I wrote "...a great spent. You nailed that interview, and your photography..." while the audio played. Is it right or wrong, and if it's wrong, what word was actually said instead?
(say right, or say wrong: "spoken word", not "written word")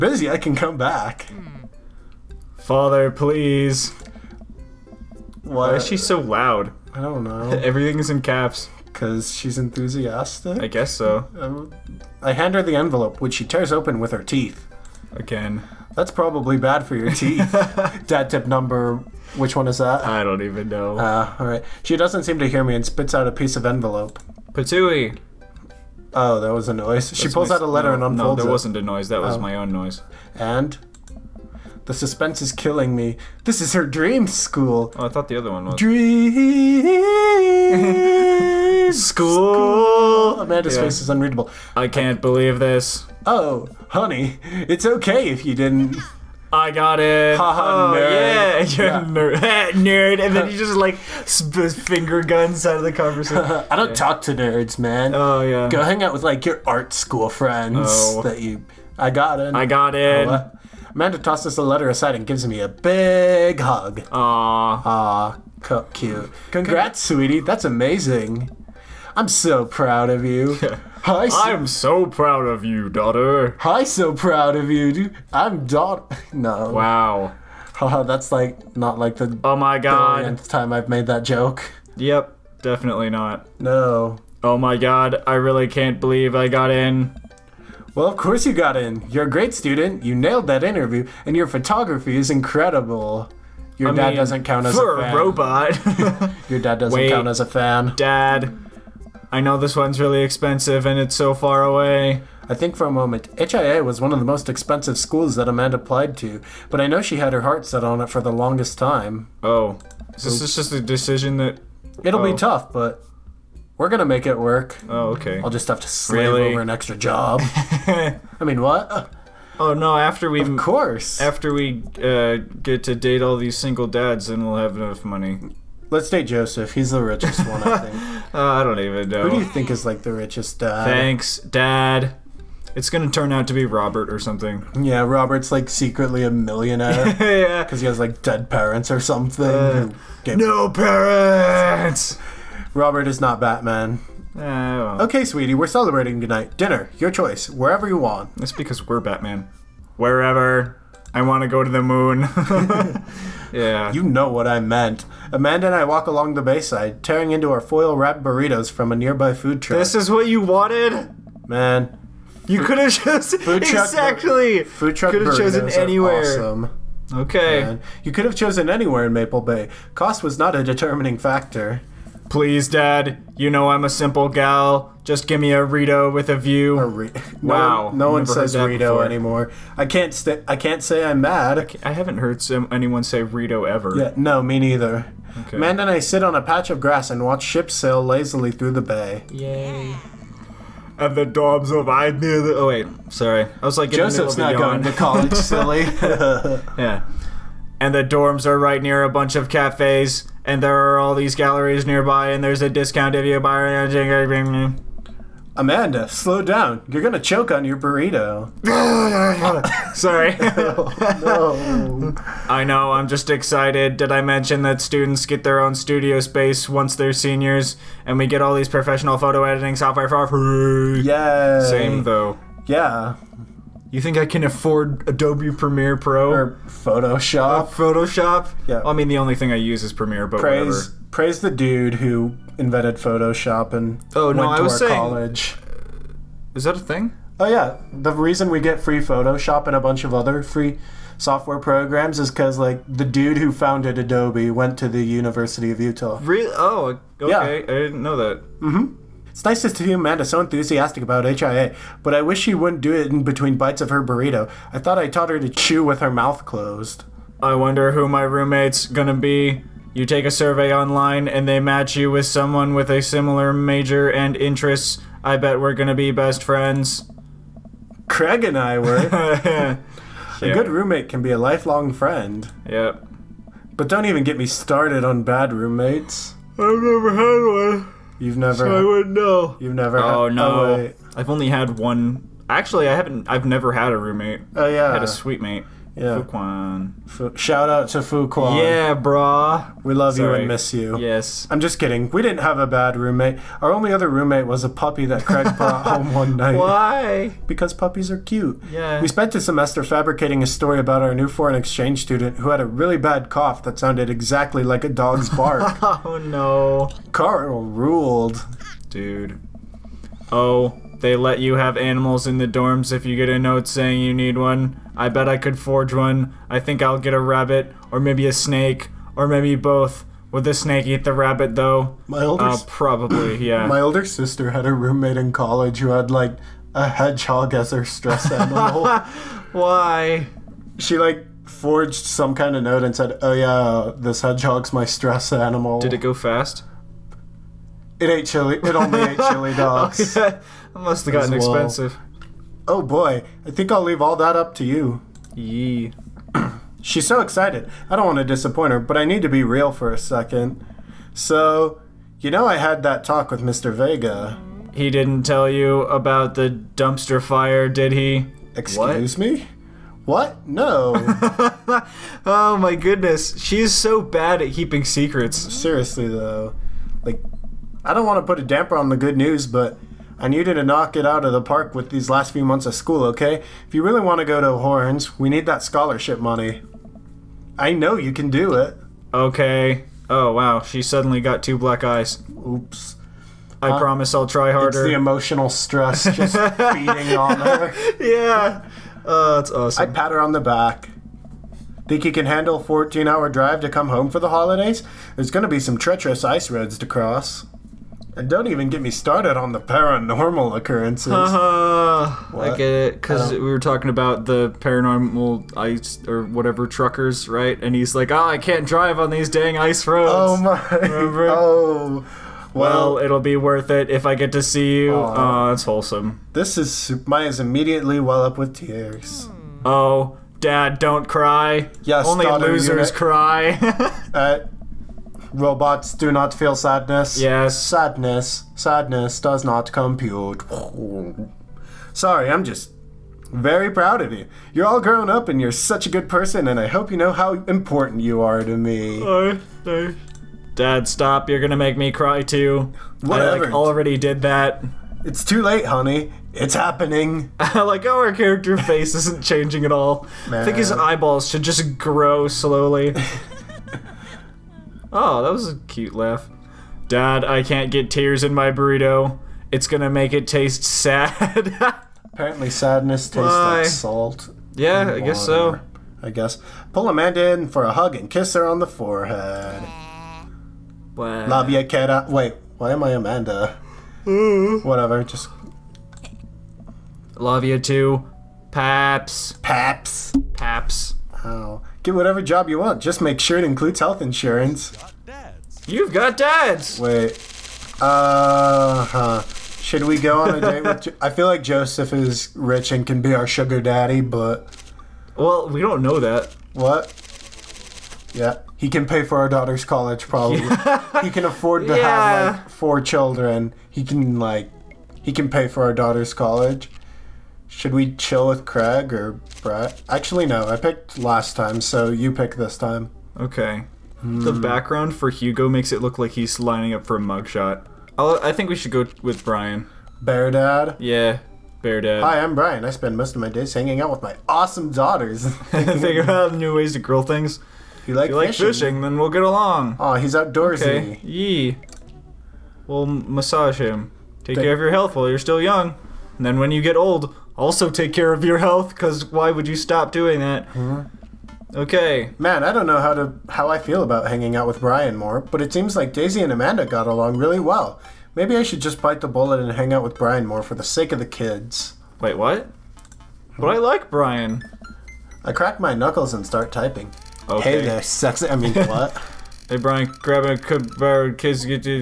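wrong: "student", not "spent".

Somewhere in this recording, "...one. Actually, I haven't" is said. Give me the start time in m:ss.
4:41.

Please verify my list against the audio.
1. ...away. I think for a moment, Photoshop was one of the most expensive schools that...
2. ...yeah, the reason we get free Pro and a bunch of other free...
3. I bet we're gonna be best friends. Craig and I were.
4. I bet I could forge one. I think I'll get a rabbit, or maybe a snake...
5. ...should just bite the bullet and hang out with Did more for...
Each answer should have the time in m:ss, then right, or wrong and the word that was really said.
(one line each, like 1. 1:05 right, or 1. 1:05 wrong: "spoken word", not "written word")
1. 1:41 wrong: "HIA", not "Photoshop"
2. 3:57 wrong: "Photoshop", not "Pro"
3. 4:25 right
4. 5:14 right
5. 9:08 wrong: "Brian", not "Did".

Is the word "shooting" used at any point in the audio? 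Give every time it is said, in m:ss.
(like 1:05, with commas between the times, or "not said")
not said.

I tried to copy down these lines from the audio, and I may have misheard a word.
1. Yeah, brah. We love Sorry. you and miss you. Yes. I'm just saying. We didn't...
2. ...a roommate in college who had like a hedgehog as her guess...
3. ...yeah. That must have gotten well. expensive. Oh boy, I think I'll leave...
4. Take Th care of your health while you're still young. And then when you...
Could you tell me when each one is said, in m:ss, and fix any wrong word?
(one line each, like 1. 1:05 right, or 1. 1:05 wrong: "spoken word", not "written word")
1. 4:48 wrong: "kidding", not "saying"
2. 5:24 wrong: "stress", not "guess"
3. 5:40 right
4. 8:54 right.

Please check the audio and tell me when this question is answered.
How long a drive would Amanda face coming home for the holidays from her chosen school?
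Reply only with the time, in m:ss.
6:32.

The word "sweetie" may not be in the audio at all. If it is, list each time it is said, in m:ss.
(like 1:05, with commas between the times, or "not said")
1:07, 2:25.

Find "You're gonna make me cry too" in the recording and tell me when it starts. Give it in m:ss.
7:21.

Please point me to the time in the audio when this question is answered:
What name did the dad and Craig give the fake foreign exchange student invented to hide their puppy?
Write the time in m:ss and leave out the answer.
5:07.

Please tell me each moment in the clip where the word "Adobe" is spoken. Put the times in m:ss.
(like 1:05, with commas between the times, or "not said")
3:45, 4:03.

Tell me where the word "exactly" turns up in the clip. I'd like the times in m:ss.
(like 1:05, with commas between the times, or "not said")
2:43, 5:04.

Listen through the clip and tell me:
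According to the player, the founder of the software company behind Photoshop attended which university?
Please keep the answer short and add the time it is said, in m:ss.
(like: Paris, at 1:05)
University of Utah, at 4:05.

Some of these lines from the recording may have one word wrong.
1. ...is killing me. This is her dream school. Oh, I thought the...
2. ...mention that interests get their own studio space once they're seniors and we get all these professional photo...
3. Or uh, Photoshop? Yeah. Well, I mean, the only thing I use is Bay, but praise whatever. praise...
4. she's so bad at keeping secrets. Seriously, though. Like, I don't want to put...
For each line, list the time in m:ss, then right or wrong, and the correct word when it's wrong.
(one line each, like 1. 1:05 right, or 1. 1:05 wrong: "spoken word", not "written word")
1. 0:32 right
2. 3:34 wrong: "students", not "interests"
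3. 3:47 wrong: "Premiere", not "Bay"
4. 6:03 right.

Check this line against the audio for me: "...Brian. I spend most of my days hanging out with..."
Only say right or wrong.
right.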